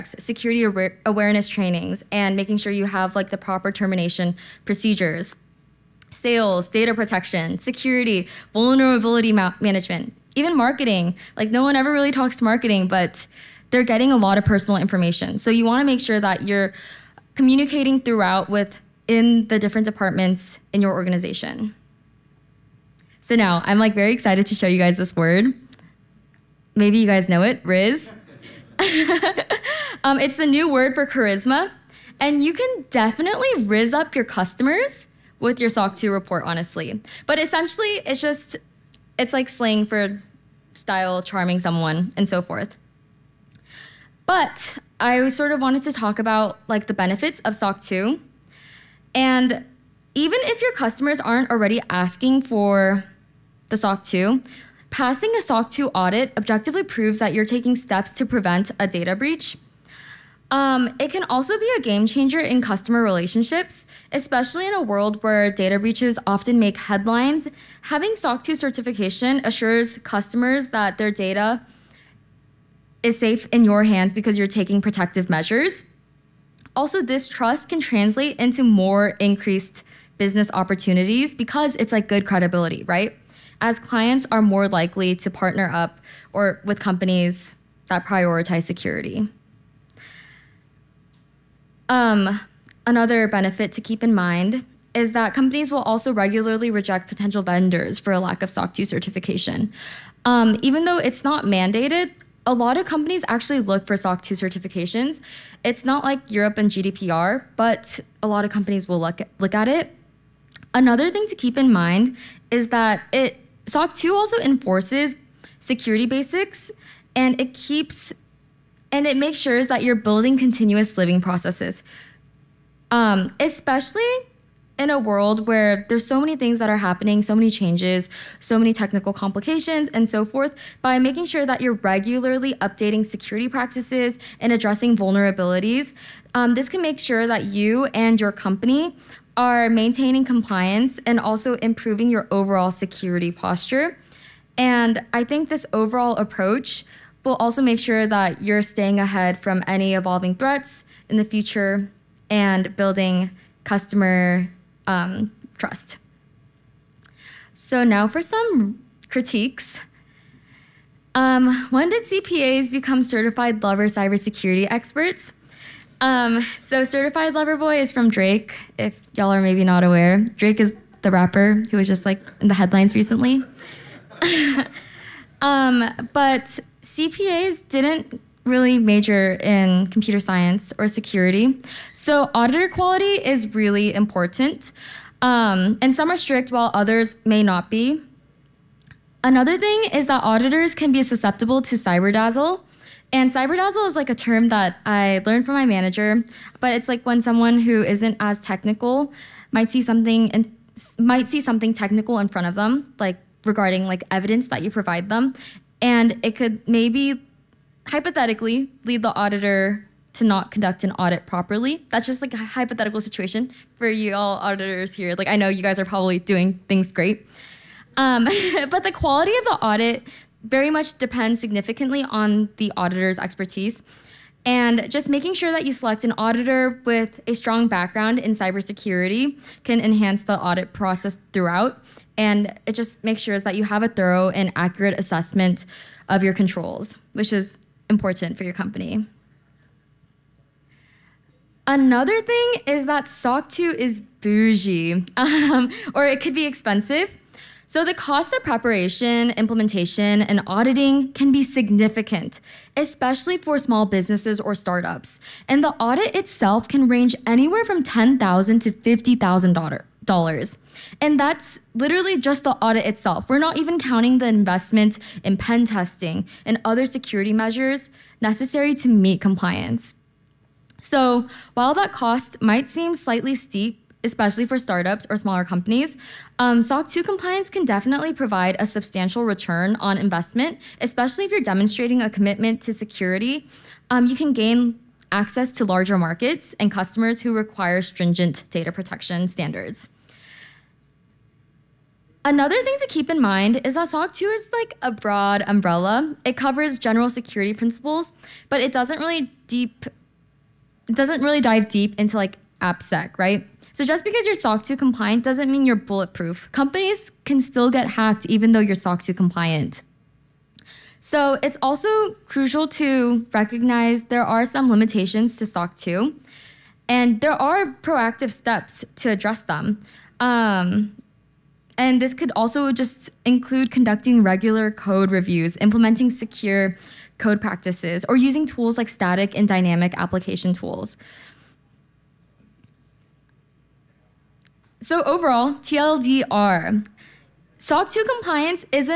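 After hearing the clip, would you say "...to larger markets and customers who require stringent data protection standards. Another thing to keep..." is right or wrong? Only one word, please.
right.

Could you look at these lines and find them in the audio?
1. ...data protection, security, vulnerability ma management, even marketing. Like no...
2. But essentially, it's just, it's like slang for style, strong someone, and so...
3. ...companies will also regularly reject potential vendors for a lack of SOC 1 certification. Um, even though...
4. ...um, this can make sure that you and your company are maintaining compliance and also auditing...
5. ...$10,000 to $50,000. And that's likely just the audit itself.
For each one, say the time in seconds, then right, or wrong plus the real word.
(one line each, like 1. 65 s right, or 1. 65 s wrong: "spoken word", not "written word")
1. 6 s right
2. 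37 s wrong: "charming", not "strong"
3. 95 s wrong: "2", not "1"
4. 136 s wrong: "improving", not "auditing"
5. 257 s wrong: "literally", not "likely".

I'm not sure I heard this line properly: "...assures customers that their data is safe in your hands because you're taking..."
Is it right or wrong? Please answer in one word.
right.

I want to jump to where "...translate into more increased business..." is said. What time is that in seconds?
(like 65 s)
77 s.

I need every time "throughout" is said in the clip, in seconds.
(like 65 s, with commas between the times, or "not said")
18 s, 231 s.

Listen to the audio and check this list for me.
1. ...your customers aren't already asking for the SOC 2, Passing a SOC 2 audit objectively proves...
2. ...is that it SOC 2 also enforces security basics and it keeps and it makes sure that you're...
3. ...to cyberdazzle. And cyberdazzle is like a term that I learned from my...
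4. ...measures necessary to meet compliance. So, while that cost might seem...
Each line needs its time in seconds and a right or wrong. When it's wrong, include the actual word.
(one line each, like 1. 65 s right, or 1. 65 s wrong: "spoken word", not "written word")
1. 50 s right
2. 112 s right
3. 191 s right
4. 267 s right.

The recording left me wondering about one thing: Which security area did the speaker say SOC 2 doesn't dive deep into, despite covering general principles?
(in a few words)
AppSec.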